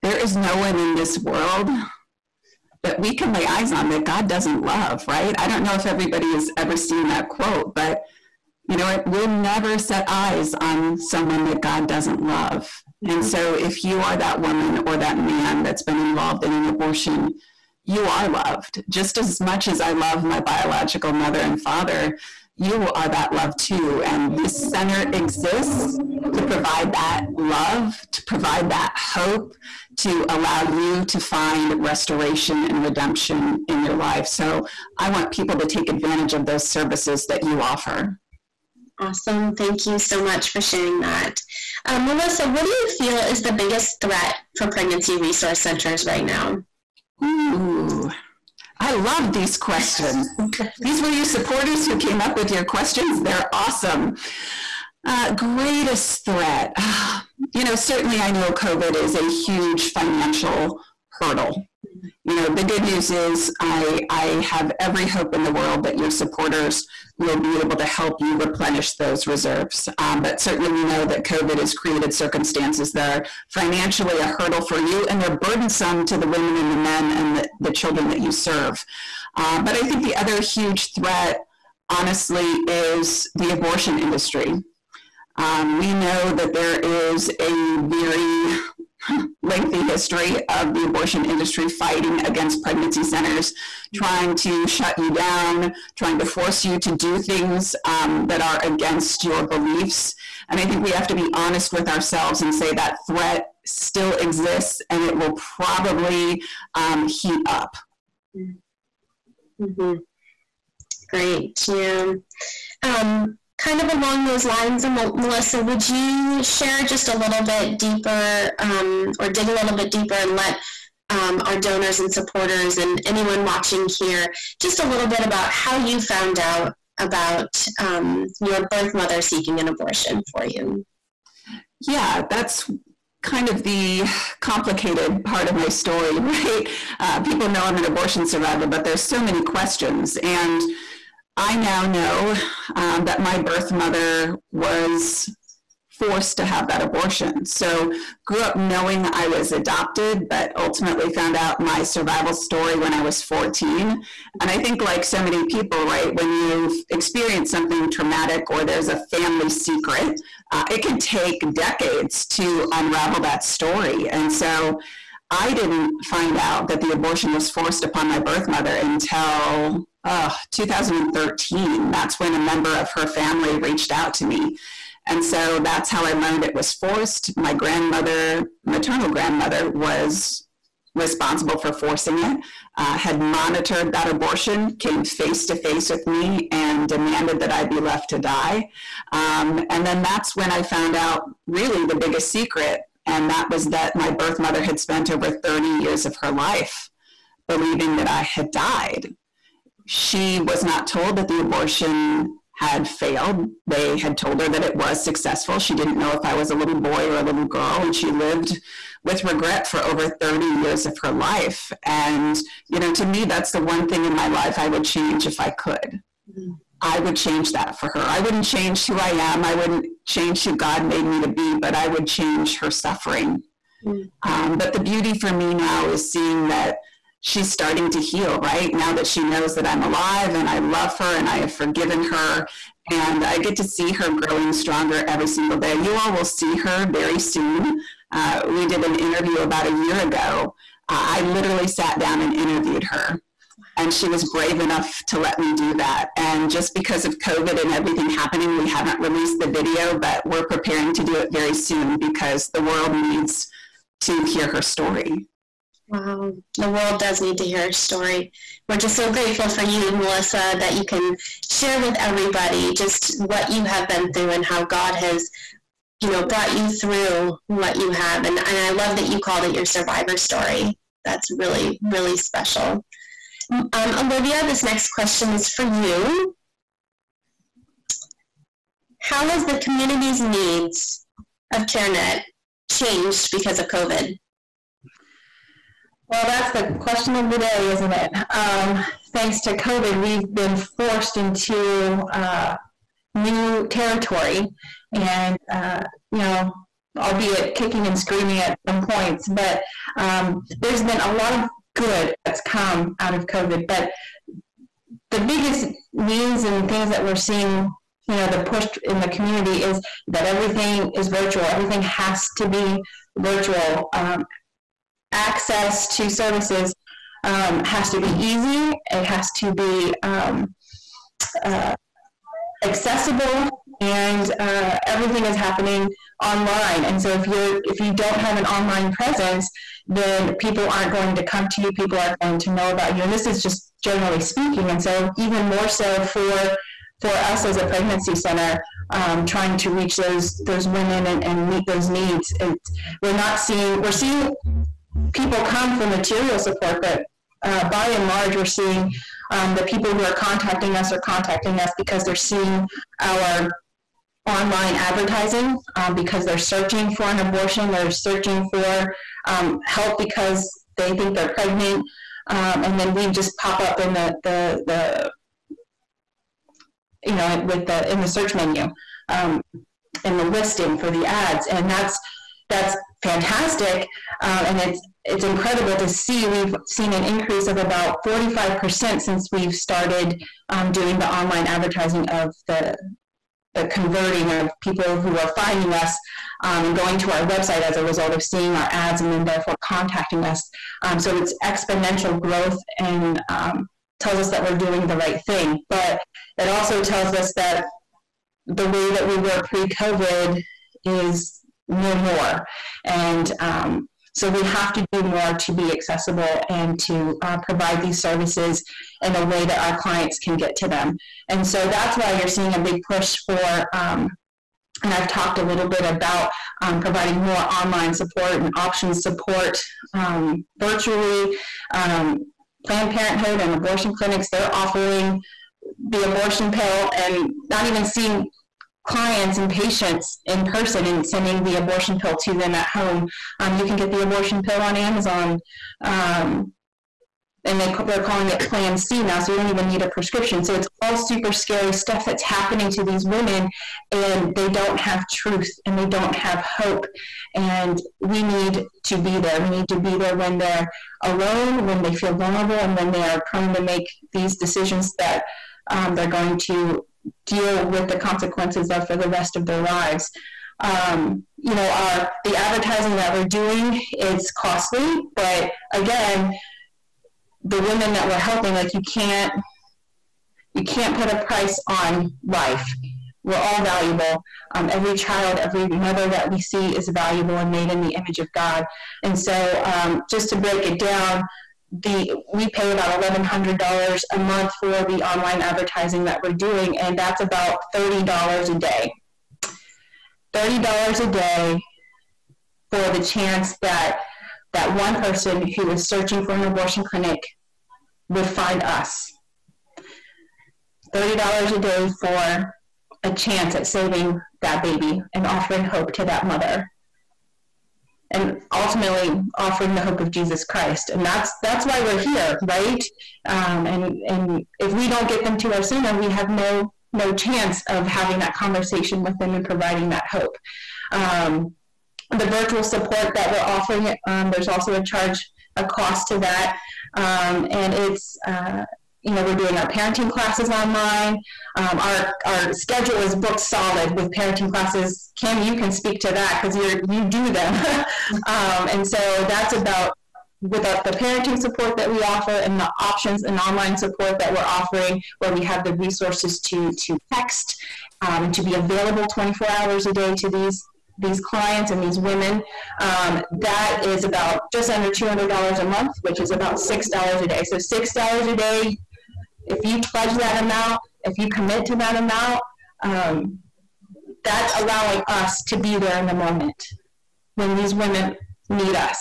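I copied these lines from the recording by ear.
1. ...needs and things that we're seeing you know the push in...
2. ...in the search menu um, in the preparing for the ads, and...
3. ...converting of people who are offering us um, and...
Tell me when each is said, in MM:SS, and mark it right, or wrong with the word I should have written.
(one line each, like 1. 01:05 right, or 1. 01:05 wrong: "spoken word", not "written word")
1. 05:05 right
2. 06:07 wrong: "listing", not "preparing"
3. 06:23 wrong: "finding", not "offering".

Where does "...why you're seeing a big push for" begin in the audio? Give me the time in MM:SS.
06:51.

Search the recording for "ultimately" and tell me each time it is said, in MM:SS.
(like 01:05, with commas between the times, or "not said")
02:30, 08:28.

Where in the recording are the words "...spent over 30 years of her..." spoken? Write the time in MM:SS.
03:14.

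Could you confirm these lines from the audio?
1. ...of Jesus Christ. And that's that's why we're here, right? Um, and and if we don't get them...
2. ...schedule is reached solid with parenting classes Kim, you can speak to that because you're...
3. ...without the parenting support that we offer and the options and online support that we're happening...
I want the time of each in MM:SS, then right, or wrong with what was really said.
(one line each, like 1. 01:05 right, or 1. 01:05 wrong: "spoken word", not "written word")
1. 08:29 right
2. 08:52 wrong: "booked", not "reached"
3. 09:00 wrong: "offering", not "happening".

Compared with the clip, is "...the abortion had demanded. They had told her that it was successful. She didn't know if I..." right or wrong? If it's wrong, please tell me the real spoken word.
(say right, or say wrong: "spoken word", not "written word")
wrong: "failed", not "demanded".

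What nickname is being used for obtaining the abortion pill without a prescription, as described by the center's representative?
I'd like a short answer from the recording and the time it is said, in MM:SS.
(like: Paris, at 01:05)
Plan C, at 07:18.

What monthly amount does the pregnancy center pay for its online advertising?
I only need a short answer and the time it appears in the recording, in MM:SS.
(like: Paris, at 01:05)
$1100, at 08:03.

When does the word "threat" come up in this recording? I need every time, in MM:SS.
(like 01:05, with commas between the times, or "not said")
00:44, 00:56, 01:20, 01:43.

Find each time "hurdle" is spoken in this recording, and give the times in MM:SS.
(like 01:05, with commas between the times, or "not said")
01:01, 01:14.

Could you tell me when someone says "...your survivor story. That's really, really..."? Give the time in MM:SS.
04:29.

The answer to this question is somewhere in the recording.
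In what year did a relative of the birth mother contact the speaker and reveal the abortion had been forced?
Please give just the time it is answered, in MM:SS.
02:50.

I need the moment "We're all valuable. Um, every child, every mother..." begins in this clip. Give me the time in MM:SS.
07:53.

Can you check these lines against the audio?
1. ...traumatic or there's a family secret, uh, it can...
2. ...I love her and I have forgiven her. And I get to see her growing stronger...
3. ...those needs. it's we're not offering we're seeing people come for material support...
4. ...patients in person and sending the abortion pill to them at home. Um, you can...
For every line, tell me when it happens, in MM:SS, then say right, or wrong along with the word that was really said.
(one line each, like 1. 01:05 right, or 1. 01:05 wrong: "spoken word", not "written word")
1. 02:37 right
2. 03:50 right
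3. 05:41 wrong: "seeing", not "offering"
4. 07:09 right.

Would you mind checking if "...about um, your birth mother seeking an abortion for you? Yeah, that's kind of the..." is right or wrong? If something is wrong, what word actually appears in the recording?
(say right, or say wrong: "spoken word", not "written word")
right.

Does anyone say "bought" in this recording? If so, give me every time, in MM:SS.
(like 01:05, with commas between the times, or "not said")
not said.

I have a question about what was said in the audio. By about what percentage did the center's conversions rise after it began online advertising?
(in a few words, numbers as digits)
45%.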